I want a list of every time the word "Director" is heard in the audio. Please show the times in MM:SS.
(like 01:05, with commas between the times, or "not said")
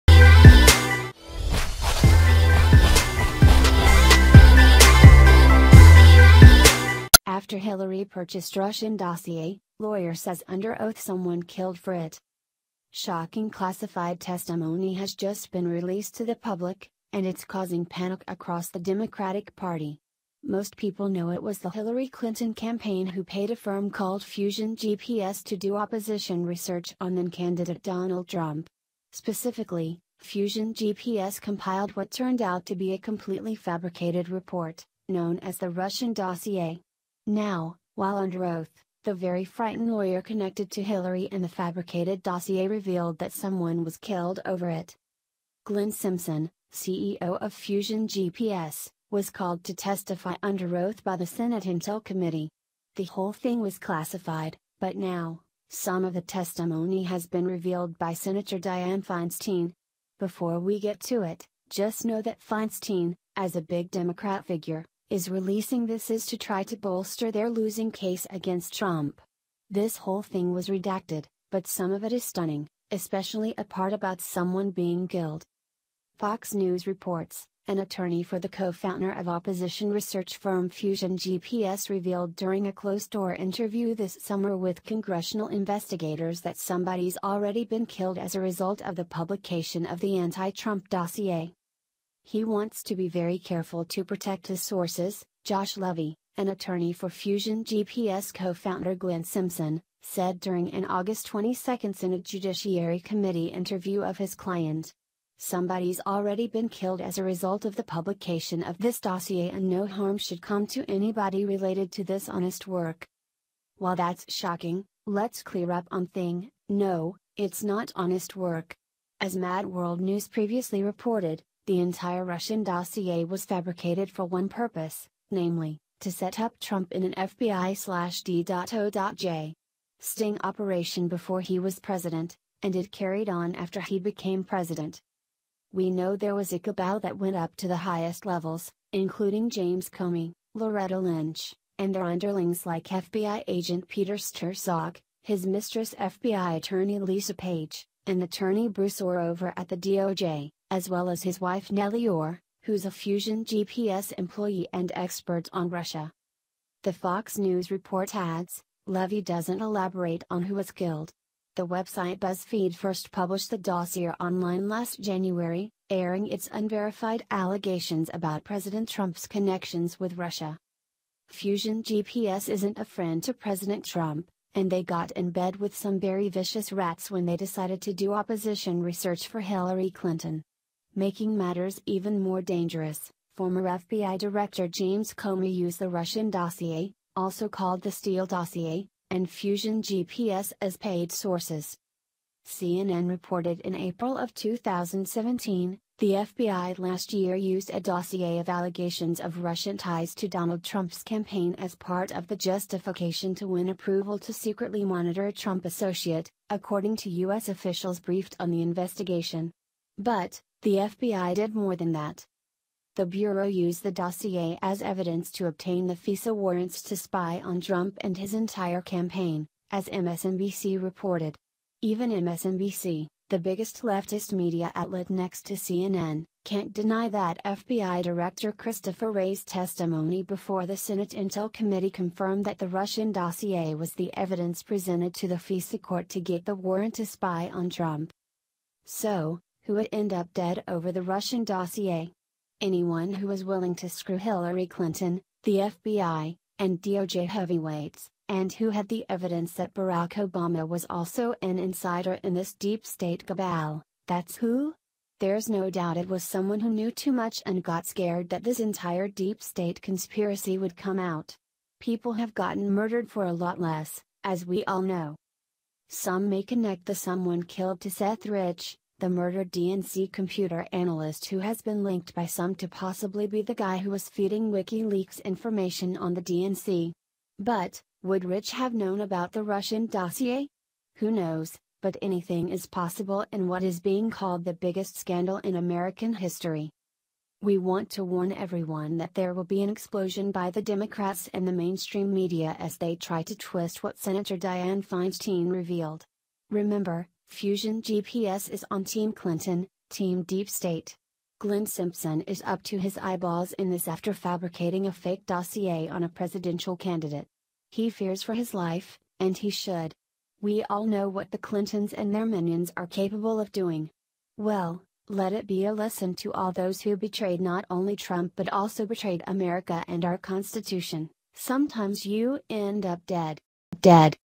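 03:04, 03:48.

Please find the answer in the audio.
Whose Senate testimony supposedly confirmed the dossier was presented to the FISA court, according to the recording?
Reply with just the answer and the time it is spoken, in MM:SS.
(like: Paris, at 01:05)
Christopher Wray, at 03:48.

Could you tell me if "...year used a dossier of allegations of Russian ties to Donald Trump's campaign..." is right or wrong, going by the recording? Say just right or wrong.
right.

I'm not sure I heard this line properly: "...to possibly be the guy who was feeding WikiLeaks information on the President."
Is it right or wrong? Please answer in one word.
wrong.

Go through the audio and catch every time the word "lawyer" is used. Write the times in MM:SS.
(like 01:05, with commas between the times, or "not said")
00:09, 00:39.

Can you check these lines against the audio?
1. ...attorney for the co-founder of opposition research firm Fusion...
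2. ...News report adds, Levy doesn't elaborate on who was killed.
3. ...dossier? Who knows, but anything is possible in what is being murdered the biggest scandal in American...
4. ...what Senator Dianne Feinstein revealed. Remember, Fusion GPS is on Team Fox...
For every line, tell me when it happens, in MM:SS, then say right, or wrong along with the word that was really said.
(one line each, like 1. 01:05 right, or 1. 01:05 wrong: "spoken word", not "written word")
1. 01:17 right
2. 02:37 right
3. 04:39 wrong: "called", not "murdered"
4. 04:53 wrong: "Clinton", not "Fox".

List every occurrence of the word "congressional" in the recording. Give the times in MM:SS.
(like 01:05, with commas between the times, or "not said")
01:24.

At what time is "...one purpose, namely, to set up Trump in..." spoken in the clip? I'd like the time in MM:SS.
02:04.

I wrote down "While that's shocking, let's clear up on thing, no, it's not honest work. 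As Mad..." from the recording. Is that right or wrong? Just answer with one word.
right.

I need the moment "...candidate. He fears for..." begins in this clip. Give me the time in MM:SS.
05:06.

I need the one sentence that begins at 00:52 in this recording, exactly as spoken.
The whole thing was classified, but now, some of the testimony has been revealed by Senator Dianne Feinstein.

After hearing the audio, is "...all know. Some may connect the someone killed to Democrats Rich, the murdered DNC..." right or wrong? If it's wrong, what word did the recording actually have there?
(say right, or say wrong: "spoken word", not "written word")
wrong: "Seth", not "Democrats".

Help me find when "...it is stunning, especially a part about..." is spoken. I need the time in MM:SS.
01:12.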